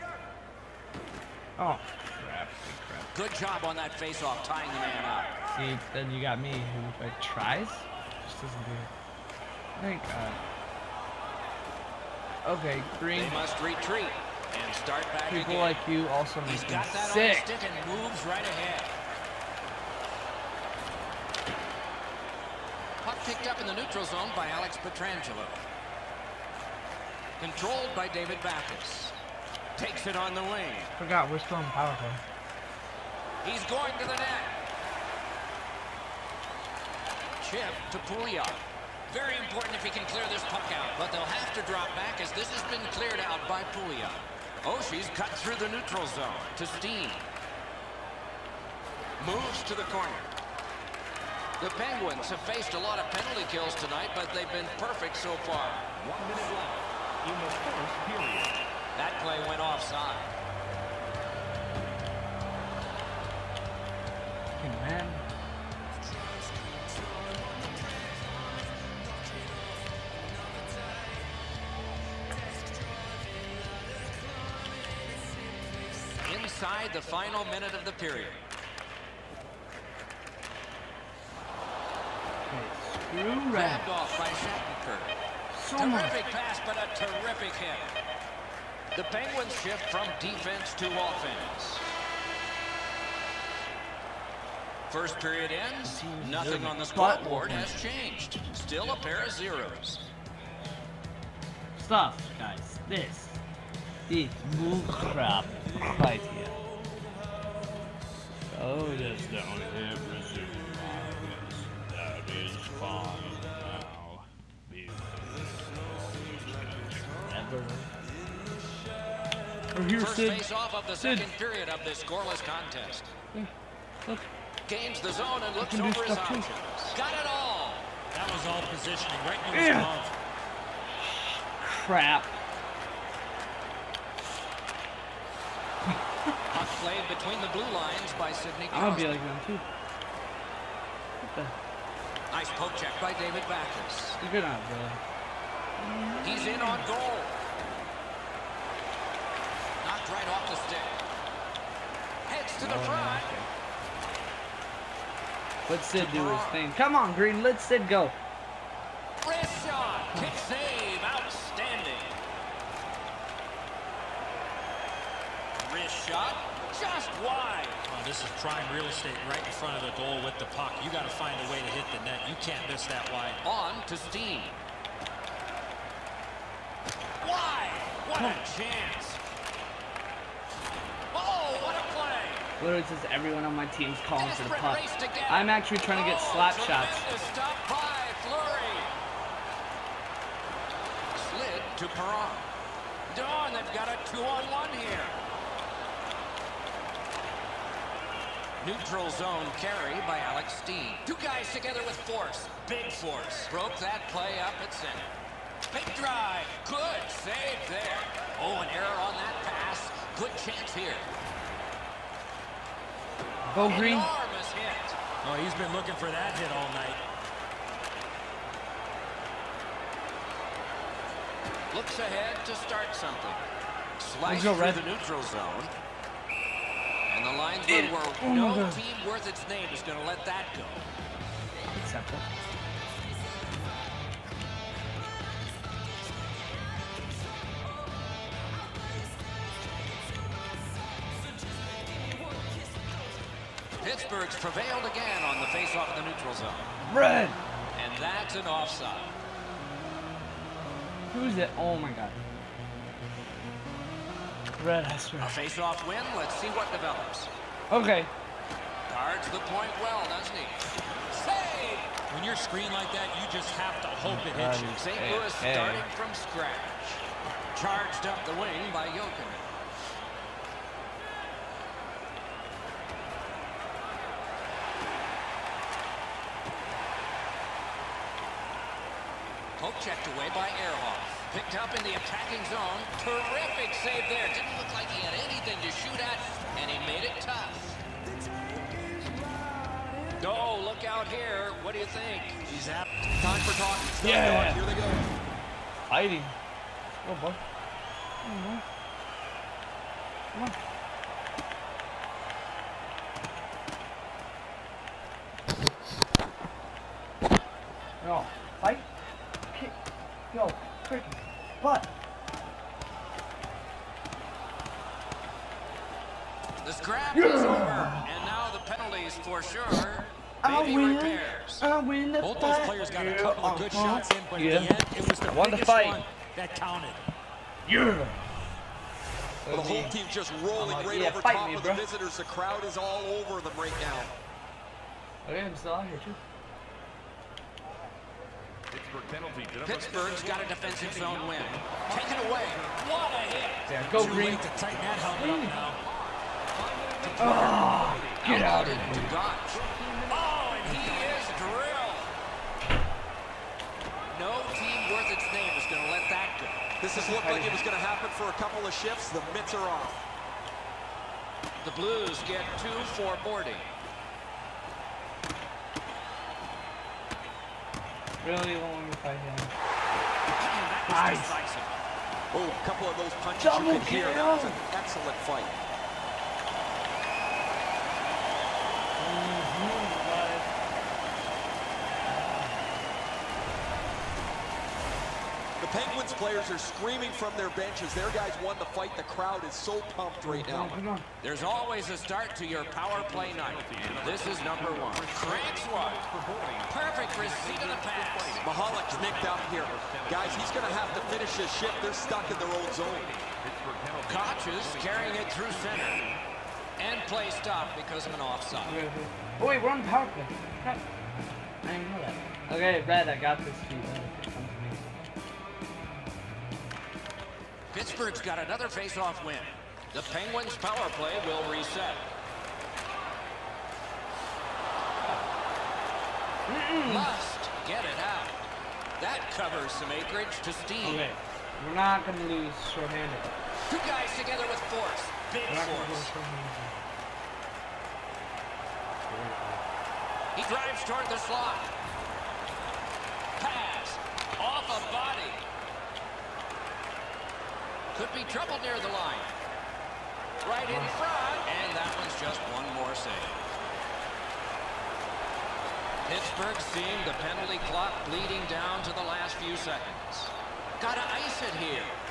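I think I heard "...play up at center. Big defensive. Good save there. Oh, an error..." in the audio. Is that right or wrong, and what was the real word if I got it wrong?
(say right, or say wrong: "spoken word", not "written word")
wrong: "drive", not "defensive".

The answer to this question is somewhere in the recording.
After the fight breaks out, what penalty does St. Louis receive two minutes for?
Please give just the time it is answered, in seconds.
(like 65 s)
363 s.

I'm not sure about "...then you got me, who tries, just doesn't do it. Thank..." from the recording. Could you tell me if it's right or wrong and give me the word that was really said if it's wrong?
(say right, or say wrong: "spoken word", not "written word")
right.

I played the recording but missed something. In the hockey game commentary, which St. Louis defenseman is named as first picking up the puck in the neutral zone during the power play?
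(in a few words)
Alex Pietrangelo.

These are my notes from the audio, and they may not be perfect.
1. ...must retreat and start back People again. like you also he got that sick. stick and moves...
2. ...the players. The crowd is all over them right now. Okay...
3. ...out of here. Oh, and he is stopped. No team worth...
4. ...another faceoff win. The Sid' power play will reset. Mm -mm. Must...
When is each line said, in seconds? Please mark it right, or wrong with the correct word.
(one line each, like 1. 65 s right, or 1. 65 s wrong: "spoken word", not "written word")
1. 13 s right
2. 331 s wrong: "visitors", not "players"
3. 348 s wrong: "drilled", not "stopped"
4. 418 s wrong: "Penguins", not "Sid".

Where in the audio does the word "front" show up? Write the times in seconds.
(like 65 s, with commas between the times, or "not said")
152 s, 169 s, 450 s.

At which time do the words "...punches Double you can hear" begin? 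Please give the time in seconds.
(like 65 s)
373 s.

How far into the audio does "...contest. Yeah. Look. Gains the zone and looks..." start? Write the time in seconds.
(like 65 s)
122 s.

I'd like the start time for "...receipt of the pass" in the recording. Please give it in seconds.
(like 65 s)
397 s.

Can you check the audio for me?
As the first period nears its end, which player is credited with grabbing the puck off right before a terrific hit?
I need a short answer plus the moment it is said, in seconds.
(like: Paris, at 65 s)
Shattenkirk, at 84 s.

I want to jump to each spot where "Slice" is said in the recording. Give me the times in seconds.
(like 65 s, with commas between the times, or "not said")
223 s.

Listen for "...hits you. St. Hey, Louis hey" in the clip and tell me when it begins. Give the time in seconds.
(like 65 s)
264 s.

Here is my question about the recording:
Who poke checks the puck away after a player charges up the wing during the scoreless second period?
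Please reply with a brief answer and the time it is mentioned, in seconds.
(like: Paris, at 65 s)
Ehrhoff, at 280 s.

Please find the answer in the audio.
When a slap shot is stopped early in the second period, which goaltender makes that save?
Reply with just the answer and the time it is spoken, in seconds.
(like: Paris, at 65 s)
Fleury, at 188 s.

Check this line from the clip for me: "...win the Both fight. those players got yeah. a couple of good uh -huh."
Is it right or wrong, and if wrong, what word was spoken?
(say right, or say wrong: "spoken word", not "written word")
right.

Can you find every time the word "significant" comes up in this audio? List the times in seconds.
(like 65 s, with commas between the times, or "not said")
not said.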